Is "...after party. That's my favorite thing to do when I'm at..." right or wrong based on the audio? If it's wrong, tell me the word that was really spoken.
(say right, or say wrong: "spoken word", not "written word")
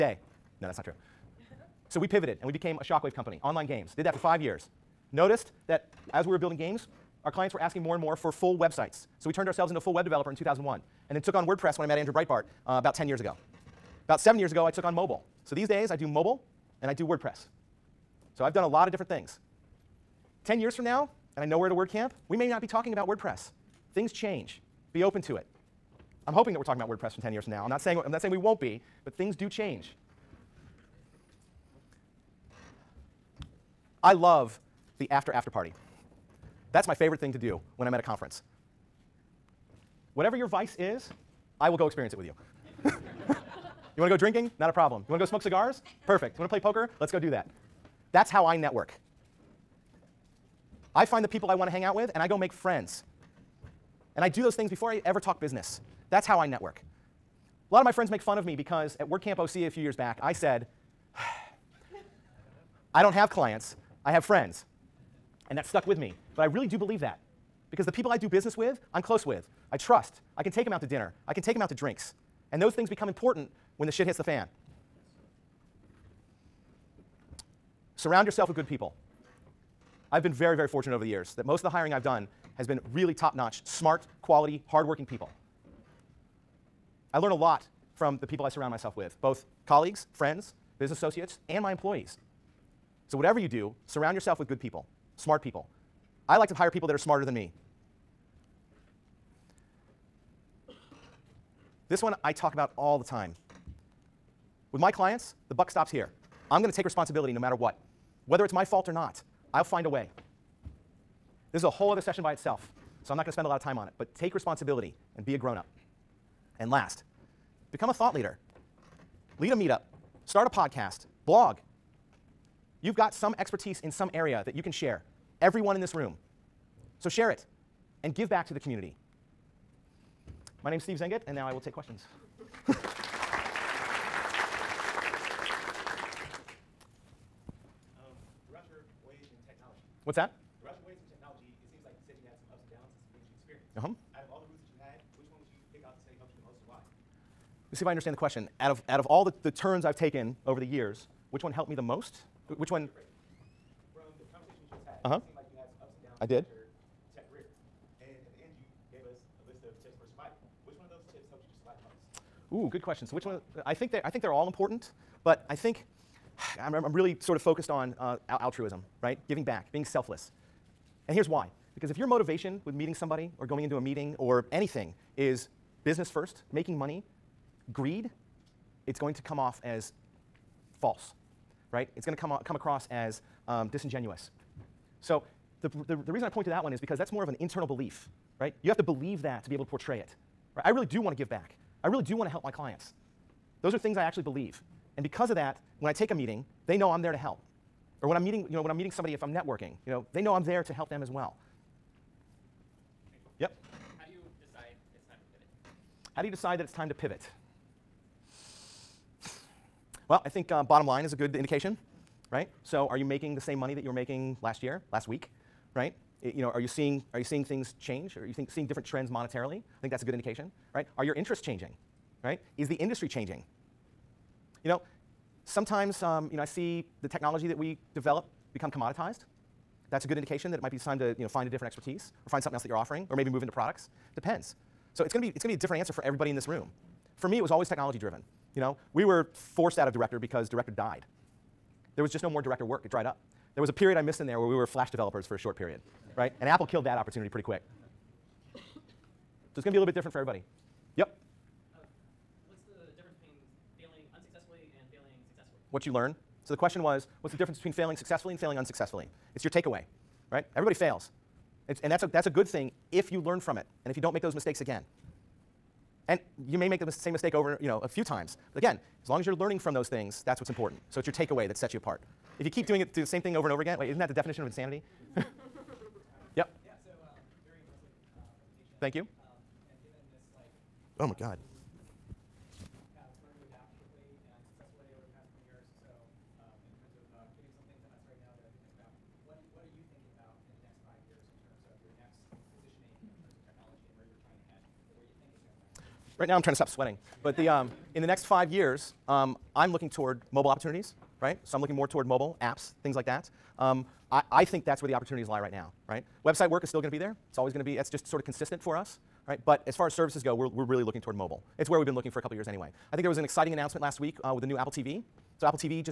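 right.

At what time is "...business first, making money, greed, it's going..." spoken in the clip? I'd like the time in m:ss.
2:55.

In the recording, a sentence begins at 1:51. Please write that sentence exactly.
This is a whole other session by itself, so I'm not going to spend a lot of time on it.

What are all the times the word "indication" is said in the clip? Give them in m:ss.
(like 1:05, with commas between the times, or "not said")
3:31, 3:40, 3:50.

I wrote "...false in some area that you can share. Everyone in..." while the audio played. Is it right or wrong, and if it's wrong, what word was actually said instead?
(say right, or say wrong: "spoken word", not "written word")
wrong: "expertise", not "false".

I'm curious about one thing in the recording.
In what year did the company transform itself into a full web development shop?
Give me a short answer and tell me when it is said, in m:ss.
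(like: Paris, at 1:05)
2001, at 0:10.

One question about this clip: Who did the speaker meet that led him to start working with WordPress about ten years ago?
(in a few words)
Andrew Breitbart.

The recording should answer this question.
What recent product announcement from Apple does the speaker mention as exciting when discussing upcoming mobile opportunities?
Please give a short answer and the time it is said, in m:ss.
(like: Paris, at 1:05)
Apple TV, at 5:14.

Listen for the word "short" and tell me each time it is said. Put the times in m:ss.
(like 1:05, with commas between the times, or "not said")
4:05.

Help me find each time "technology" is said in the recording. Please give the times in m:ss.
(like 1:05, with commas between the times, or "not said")
2:21, 3:47, 3:57.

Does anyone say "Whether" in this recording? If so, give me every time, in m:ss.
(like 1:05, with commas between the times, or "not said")
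1:48.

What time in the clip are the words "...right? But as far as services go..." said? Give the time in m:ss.
5:09.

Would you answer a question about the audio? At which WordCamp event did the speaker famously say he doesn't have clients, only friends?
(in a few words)
WordCamp OC.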